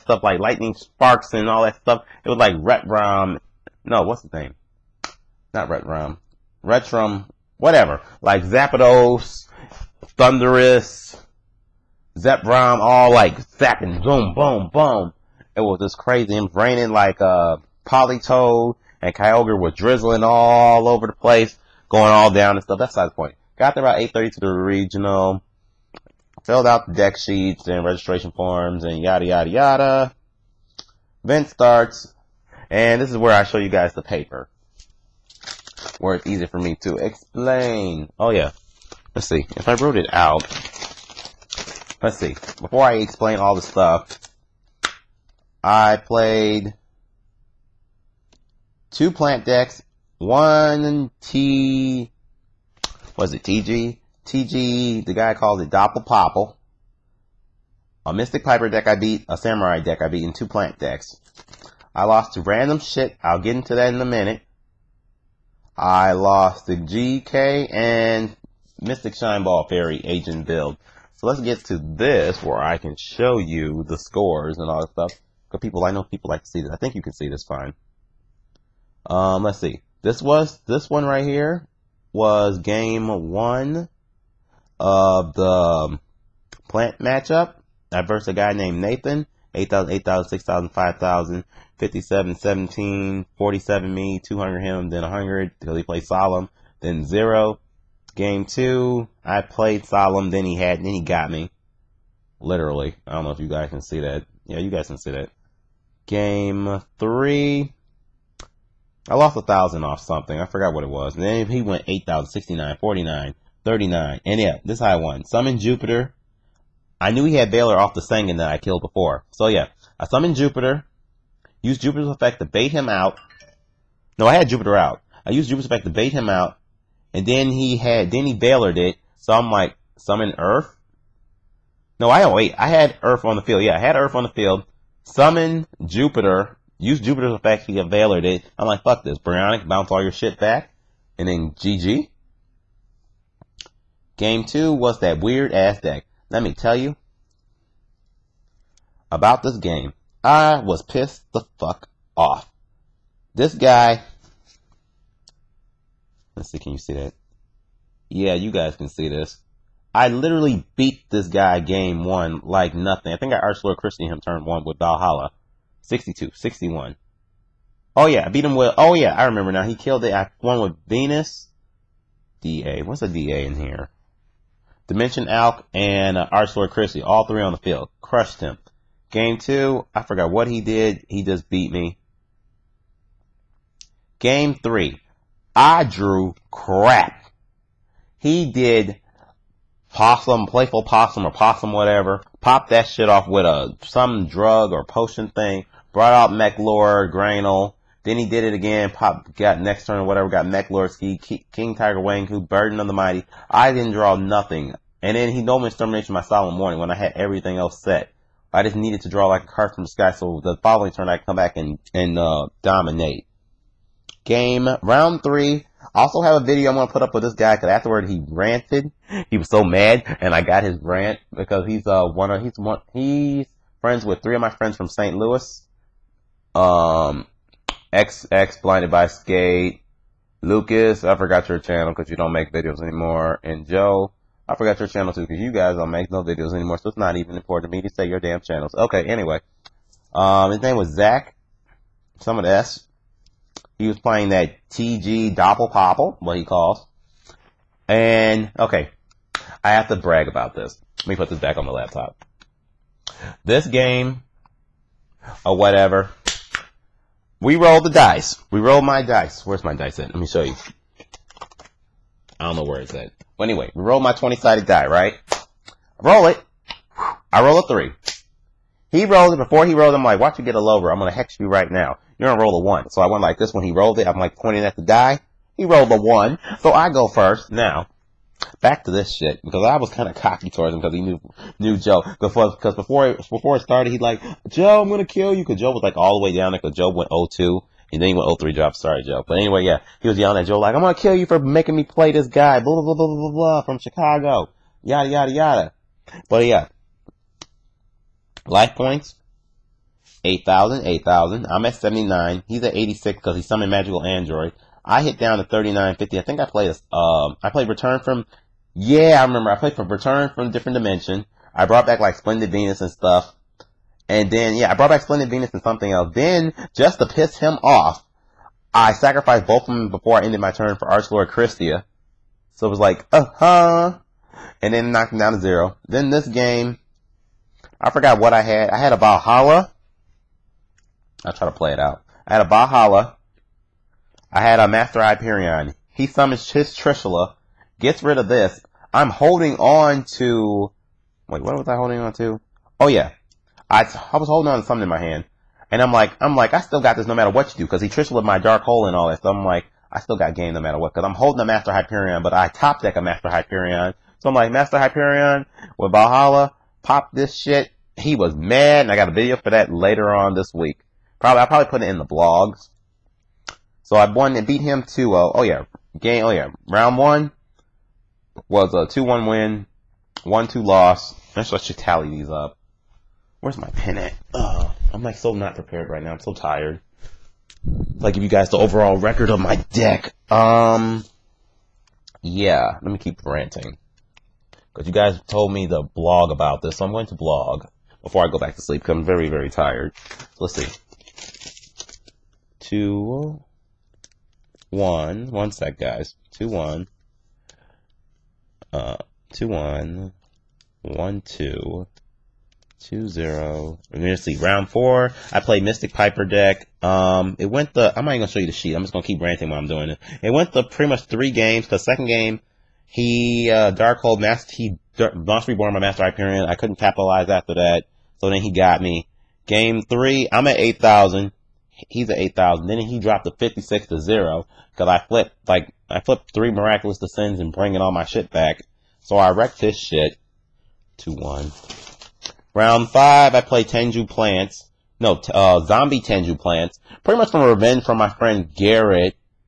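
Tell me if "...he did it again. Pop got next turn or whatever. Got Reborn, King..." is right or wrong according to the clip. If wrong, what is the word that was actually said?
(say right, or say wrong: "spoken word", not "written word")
wrong: "McLorsky", not "Reborn".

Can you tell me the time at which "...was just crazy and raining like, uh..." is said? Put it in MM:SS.
00:15.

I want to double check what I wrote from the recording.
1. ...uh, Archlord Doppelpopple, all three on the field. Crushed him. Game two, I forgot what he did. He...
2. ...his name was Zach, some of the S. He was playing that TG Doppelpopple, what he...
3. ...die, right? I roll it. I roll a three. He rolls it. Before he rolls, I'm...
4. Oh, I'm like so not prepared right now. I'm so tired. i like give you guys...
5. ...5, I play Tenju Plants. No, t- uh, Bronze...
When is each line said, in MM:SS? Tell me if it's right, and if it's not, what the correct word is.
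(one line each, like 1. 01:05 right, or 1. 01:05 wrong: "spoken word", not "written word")
1. 02:56 wrong: "Kristya", not "Doppelpopple"
2. 04:00 right
3. 04:24 right
4. 06:14 right
5. 07:12 wrong: "Zombie", not "Bronze".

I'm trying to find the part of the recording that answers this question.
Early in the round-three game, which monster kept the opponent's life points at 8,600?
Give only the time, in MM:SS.
05:03.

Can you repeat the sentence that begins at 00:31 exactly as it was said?
Event starts, and this is where I show you guys the paper, where it's easy for me to explain.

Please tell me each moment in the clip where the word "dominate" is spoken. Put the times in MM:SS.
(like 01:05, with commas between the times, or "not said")
03:32.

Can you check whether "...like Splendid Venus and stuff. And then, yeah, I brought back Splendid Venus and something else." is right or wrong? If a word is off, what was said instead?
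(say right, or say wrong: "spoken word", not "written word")
right.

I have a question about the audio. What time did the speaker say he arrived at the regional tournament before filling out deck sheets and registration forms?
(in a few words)
8:30.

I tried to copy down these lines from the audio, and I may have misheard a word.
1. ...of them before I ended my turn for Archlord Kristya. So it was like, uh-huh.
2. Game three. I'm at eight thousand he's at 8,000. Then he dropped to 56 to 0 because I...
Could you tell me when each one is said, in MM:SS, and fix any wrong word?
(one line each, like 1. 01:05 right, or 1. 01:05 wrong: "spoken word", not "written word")
1. 05:19 right
2. 06:59 right.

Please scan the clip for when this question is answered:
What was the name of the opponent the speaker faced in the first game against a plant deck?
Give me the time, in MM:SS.
01:28.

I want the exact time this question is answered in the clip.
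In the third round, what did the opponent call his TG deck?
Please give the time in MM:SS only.
00:55.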